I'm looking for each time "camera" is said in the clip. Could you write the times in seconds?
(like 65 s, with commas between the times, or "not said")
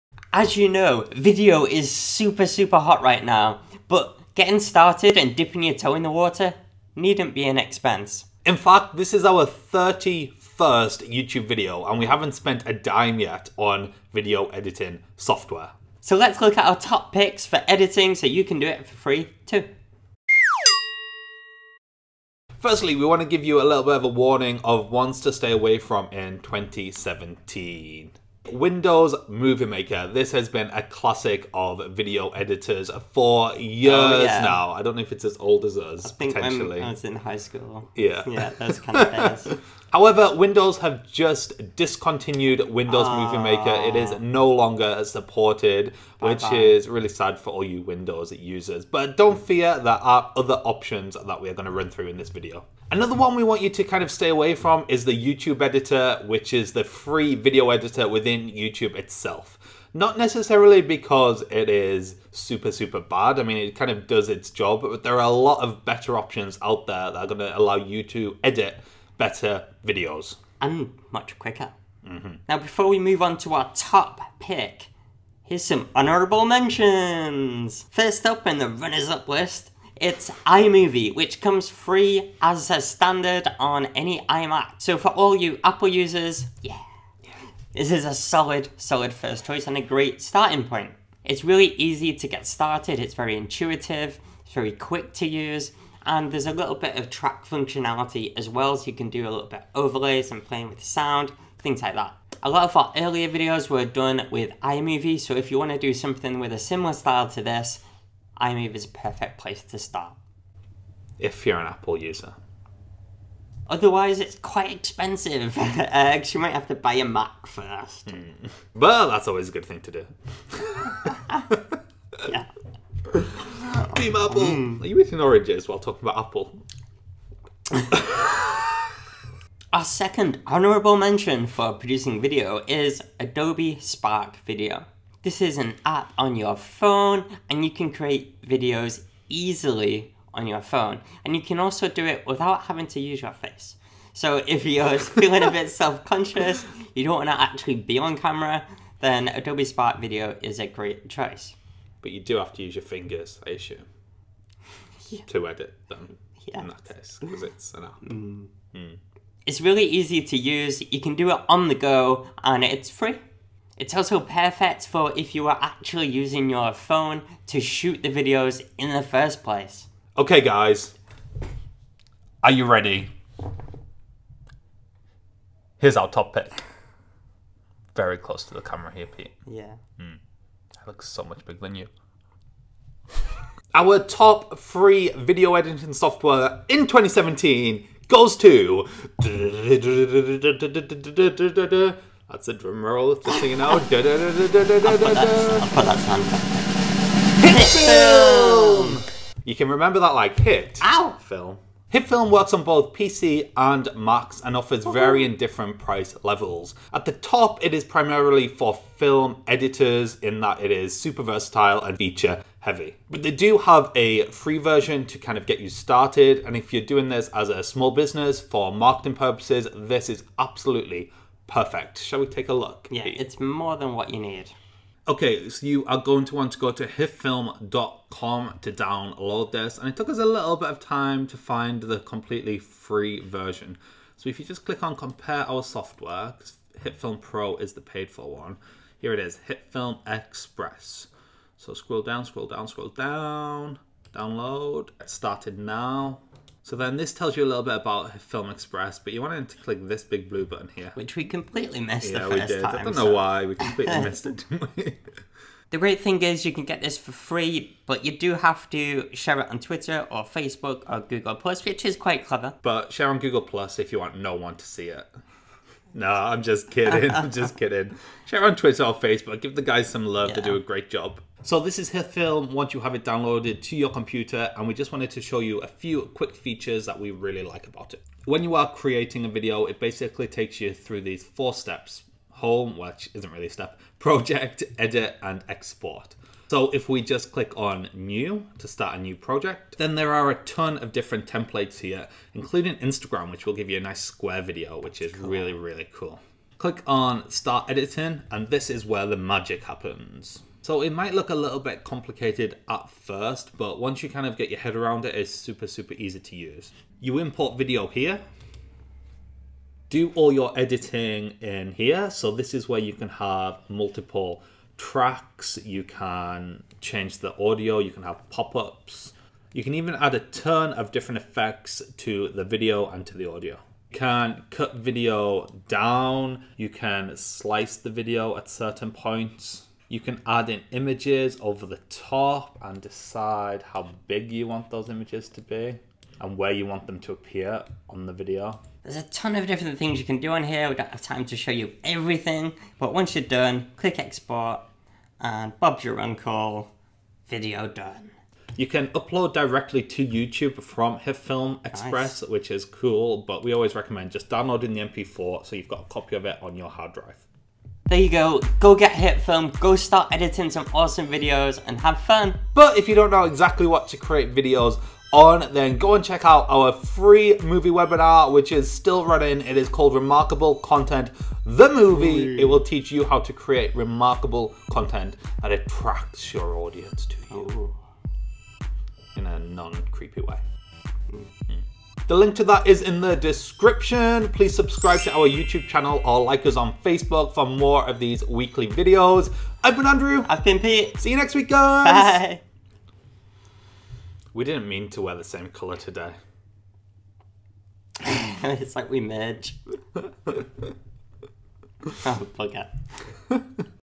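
148 s, 178 s.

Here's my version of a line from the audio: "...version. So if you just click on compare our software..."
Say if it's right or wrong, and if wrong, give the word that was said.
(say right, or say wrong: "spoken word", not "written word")
right.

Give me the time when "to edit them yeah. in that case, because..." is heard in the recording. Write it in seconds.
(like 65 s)
155 s.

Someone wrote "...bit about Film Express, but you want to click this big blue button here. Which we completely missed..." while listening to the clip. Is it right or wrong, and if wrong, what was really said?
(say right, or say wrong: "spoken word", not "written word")
right.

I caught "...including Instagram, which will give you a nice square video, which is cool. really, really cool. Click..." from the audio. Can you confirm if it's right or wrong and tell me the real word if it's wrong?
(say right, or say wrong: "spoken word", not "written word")
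right.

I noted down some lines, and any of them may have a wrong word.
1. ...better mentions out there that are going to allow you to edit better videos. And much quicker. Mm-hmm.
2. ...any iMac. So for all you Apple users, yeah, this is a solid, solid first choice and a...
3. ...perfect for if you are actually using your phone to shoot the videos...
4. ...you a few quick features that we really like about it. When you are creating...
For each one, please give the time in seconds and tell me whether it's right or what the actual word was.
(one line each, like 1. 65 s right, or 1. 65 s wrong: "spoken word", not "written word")
1. 65 s wrong: "options", not "mentions"
2. 83 s right
3. 164 s right
4. 275 s right.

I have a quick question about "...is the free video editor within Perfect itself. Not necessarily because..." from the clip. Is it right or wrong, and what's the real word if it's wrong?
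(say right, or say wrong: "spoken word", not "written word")
wrong: "YouTube", not "Perfect".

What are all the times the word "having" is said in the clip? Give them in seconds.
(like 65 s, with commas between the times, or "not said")
142 s.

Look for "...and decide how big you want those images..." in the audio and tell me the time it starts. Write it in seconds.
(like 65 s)
332 s.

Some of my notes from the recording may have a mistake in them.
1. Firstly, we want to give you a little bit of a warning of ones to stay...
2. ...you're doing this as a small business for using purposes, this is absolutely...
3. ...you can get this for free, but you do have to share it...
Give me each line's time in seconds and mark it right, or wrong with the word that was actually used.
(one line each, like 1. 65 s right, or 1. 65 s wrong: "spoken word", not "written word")
1. 22 s right
2. 216 s wrong: "marketing", not "using"
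3. 256 s right.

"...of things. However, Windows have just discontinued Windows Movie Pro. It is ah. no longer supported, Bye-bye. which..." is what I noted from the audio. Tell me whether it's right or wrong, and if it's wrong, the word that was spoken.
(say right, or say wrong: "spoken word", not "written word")
wrong: "Maker", not "Pro".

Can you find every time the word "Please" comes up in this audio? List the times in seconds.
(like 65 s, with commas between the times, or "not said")
384 s.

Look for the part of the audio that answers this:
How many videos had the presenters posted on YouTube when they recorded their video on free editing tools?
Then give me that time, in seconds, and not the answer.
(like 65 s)
9 s.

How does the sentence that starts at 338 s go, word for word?
There's a ton of different things you can do on here.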